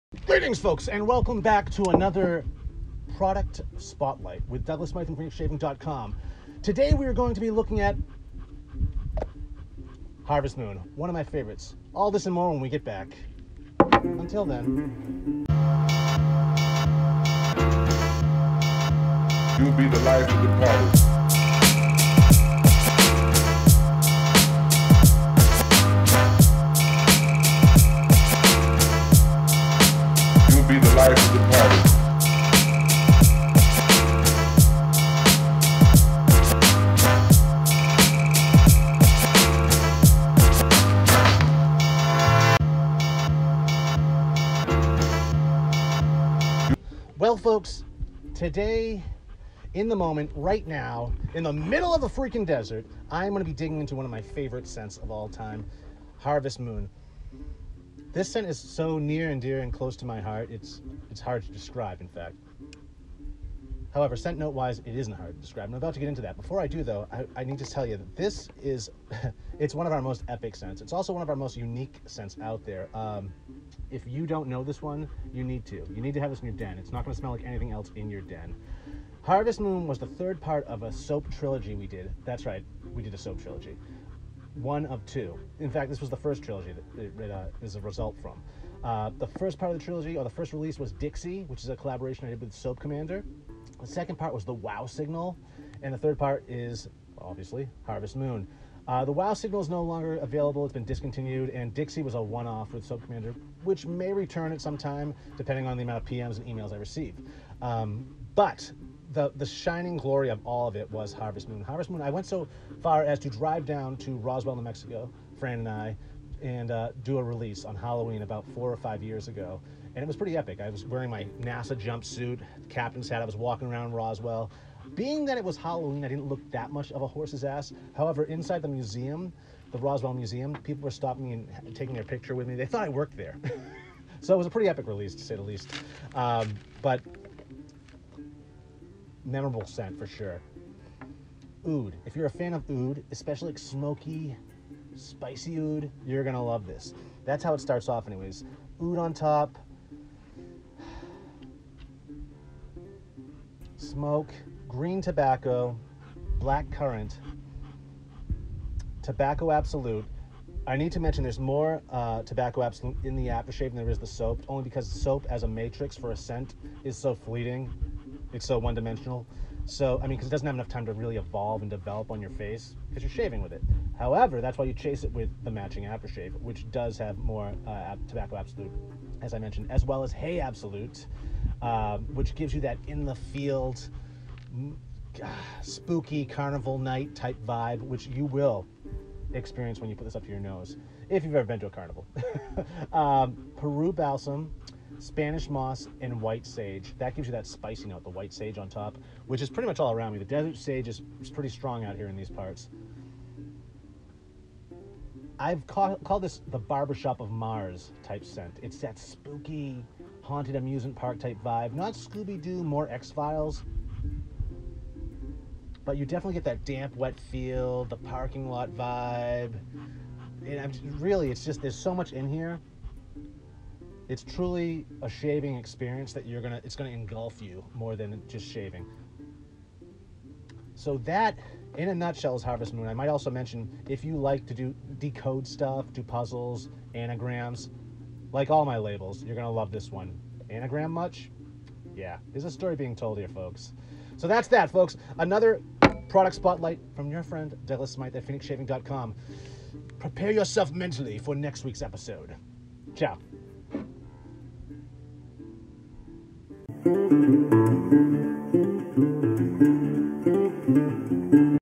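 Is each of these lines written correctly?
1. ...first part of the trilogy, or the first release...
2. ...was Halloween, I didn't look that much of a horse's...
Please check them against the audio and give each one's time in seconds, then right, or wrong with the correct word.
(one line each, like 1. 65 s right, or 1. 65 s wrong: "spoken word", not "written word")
1. 89 s right
2. 125 s right.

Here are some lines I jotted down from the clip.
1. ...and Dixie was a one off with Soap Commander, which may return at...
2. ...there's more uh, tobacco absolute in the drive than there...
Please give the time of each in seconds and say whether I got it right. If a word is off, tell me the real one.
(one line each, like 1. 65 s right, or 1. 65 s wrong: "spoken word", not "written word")
1. 101 s right
2. 161 s wrong: "aftershave", not "drive".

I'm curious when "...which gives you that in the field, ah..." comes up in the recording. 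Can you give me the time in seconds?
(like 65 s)
181 s.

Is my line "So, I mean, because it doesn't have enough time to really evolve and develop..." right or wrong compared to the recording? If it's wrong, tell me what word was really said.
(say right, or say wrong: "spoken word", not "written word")
right.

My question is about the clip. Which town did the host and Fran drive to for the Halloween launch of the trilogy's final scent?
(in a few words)
Roswell, New Mexico.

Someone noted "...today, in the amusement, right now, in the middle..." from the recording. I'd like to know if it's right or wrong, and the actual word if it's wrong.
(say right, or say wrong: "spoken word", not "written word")
wrong: "moment", not "amusement".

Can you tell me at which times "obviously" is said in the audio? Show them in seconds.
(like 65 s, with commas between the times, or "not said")
97 s.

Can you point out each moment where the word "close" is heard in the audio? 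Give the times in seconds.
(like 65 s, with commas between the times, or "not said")
59 s.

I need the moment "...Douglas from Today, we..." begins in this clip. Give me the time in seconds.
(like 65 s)
4 s.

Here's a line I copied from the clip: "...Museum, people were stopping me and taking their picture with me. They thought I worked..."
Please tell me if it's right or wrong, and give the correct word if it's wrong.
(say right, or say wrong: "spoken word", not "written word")
right.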